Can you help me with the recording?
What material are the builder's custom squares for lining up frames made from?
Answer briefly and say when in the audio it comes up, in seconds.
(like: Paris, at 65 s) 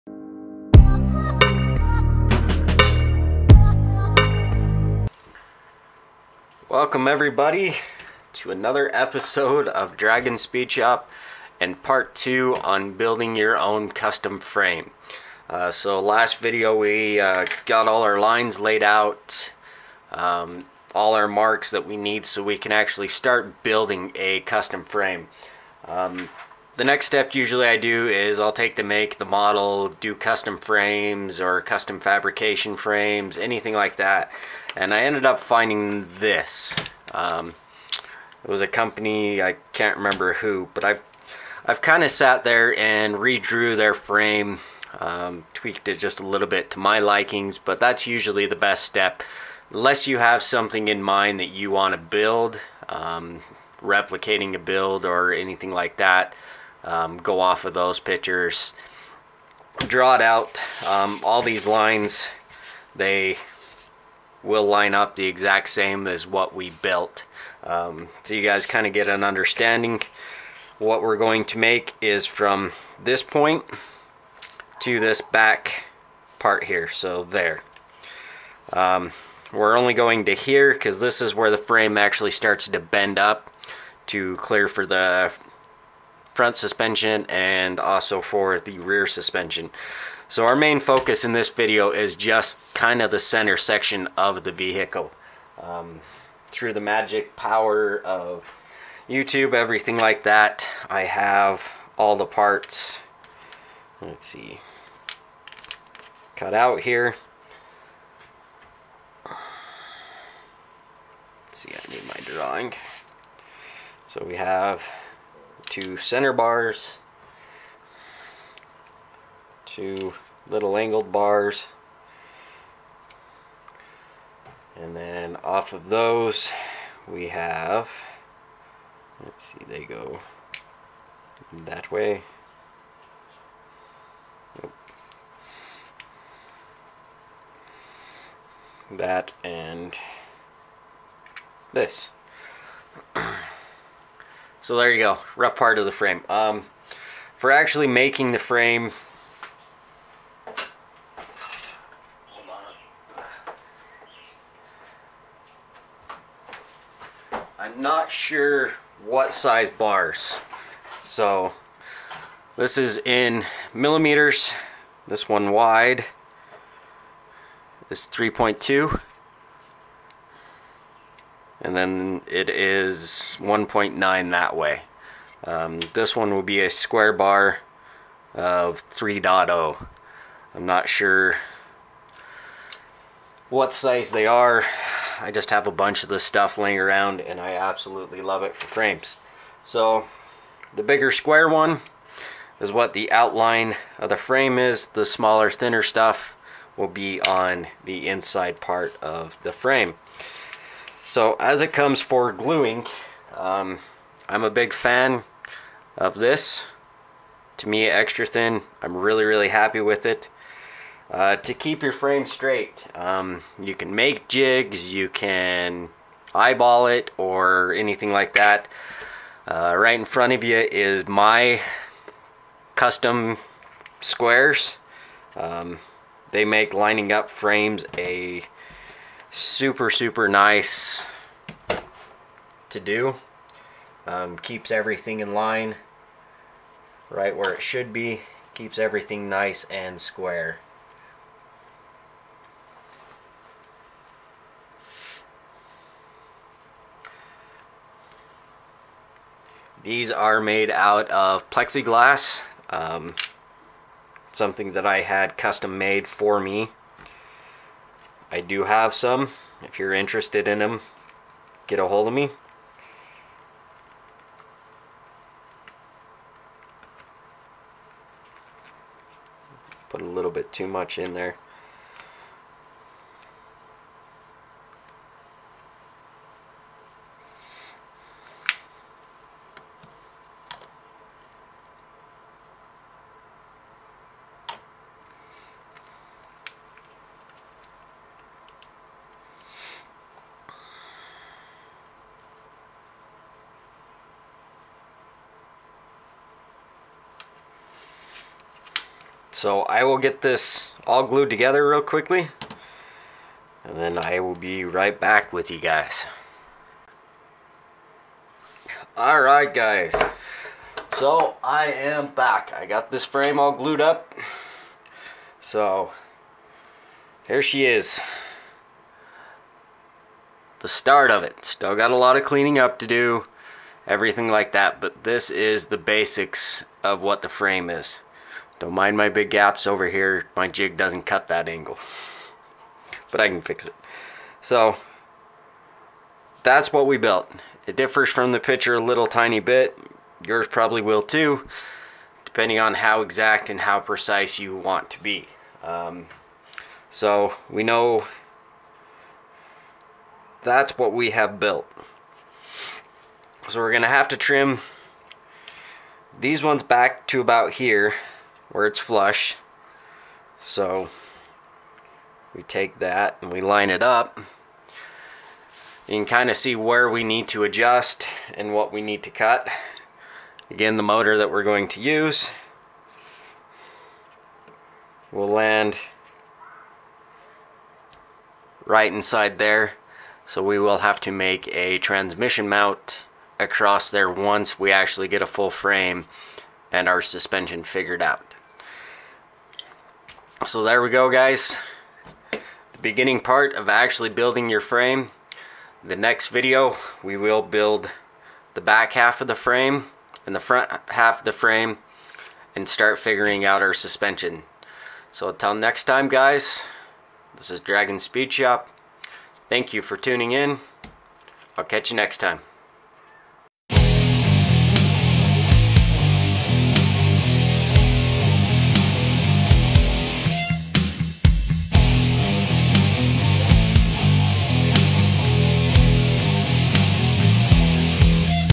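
Plexiglass, at 251 s.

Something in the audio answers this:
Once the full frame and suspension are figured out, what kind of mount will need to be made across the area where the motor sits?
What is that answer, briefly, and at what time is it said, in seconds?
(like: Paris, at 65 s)
Transmission mount, at 381 s.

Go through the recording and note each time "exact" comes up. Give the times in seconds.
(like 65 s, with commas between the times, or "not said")
65 s, 343 s.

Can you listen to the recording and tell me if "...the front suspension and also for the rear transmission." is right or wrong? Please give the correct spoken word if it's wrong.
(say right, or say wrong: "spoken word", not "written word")
wrong: "suspension", not "transmission".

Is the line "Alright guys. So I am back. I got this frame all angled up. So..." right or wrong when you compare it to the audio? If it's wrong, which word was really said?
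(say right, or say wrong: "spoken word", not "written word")
wrong: "glued", not "angled".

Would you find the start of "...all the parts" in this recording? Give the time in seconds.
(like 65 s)
101 s.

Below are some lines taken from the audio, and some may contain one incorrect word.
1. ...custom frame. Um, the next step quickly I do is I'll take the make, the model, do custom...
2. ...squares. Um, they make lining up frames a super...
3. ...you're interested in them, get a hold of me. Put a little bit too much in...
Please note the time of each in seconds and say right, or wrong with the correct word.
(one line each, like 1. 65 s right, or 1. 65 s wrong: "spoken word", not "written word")
1. 24 s wrong: "usually", not "quickly"
2. 223 s right
3. 259 s right.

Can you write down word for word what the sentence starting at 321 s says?
Still got a lot of cleaning up to do.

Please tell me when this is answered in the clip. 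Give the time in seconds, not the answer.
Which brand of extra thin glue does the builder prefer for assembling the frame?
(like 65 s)
207 s.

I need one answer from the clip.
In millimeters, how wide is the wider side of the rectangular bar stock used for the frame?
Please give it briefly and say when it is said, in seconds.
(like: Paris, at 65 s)
3.2, at 168 s.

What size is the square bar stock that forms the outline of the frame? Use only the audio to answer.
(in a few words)
3.0.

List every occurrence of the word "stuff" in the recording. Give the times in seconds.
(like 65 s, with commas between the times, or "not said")
186 s, 195 s.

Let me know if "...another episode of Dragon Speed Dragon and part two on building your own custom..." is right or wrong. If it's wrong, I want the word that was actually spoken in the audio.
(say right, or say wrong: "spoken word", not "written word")
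wrong: "Shop", not "Dragon".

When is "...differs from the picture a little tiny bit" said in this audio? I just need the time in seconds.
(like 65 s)
337 s.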